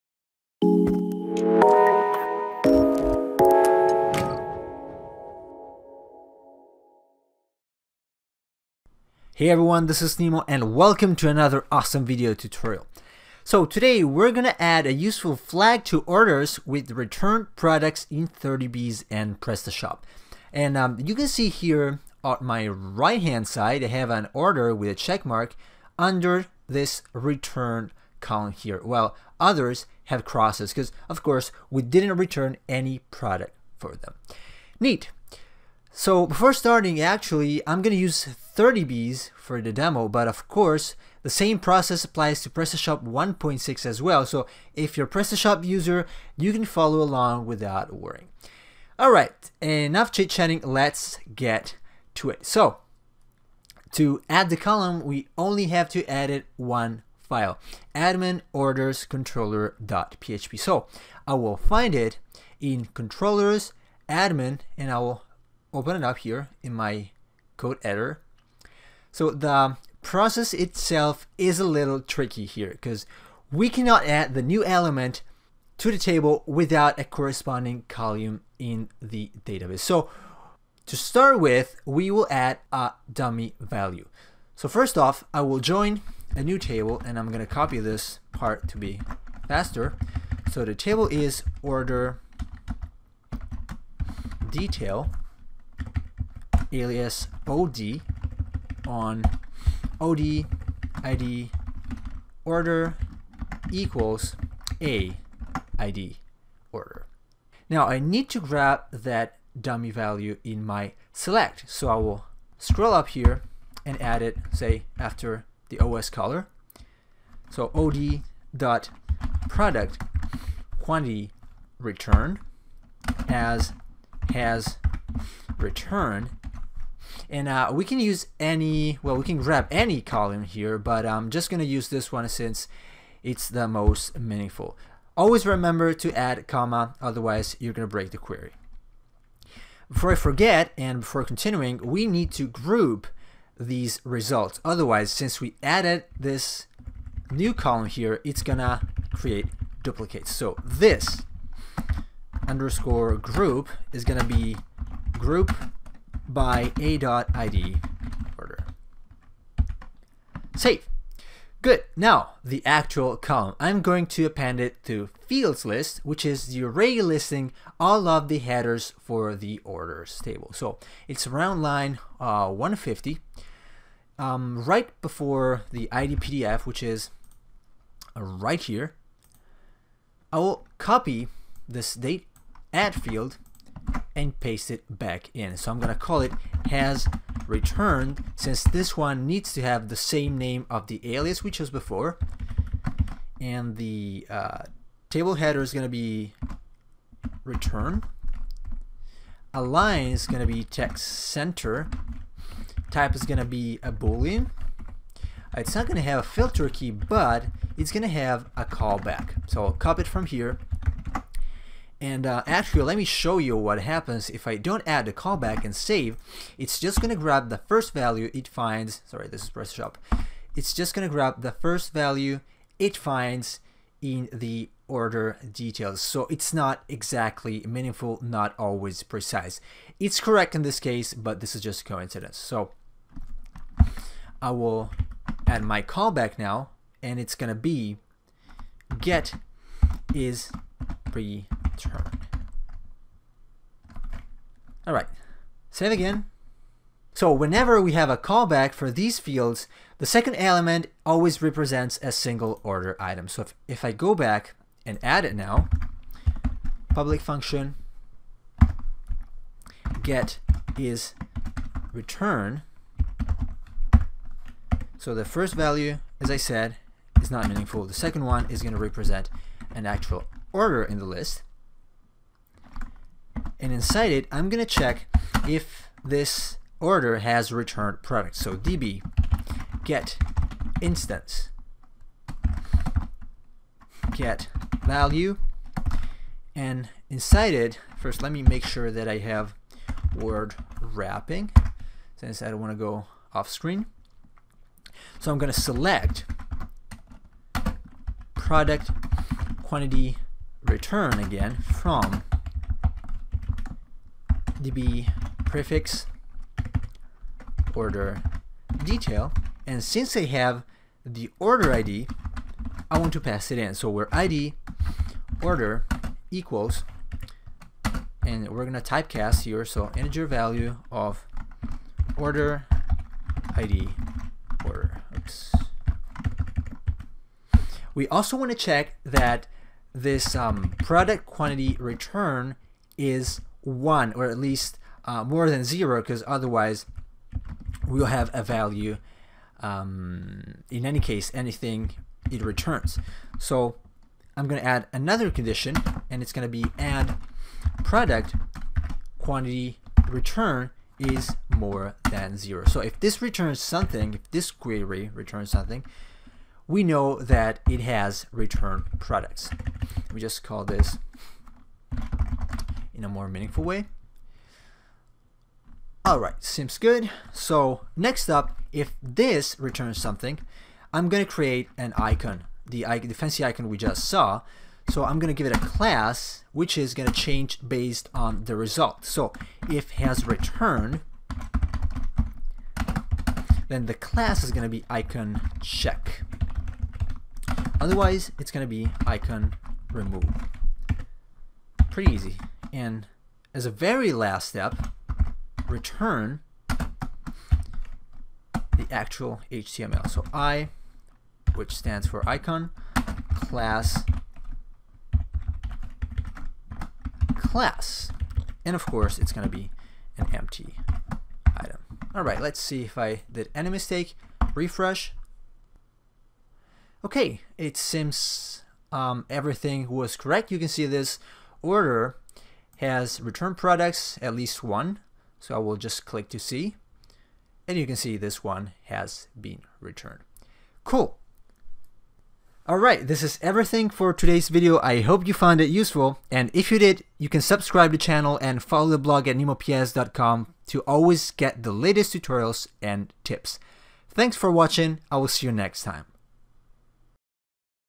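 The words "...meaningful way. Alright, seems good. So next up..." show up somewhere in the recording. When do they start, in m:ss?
6:03.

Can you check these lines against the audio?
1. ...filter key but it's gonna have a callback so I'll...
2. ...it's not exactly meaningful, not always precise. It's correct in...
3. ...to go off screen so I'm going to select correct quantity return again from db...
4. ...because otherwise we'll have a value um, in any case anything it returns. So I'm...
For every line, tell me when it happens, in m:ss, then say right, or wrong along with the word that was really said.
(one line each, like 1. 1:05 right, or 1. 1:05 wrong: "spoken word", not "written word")
1. 3:26 right
2. 3:46 right
3. 4:52 wrong: "product", not "correct"
4. 5:36 right.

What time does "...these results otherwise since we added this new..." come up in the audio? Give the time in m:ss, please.
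2:23.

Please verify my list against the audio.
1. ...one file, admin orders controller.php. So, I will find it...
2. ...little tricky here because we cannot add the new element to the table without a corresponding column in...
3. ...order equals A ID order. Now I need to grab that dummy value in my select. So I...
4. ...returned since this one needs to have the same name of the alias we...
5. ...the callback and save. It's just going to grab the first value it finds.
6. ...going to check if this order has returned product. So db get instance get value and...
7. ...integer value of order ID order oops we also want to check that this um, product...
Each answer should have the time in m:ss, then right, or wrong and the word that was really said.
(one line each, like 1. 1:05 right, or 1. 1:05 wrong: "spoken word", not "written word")
1. 0:56 right
2. 1:11 right
3. 1:42 right
4. 3:07 right
5. 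3:35 right
6. 4:34 right
7. 5:19 right.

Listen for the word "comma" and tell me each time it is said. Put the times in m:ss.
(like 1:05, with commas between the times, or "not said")
2:16.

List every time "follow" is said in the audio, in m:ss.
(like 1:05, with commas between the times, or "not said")
0:46, 7:18.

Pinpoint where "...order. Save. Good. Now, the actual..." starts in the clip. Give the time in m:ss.
2:38.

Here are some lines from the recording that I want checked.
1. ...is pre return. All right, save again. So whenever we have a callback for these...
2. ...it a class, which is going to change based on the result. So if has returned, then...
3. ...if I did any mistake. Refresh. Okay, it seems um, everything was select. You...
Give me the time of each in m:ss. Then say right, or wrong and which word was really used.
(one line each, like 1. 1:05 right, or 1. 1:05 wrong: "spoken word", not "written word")
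1. 4:00 right
2. 6:15 right
3. 6:52 wrong: "correct", not "select".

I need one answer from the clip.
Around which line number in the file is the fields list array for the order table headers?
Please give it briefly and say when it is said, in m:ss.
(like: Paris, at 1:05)
150, at 2:52.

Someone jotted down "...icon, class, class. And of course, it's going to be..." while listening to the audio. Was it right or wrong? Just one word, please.
right.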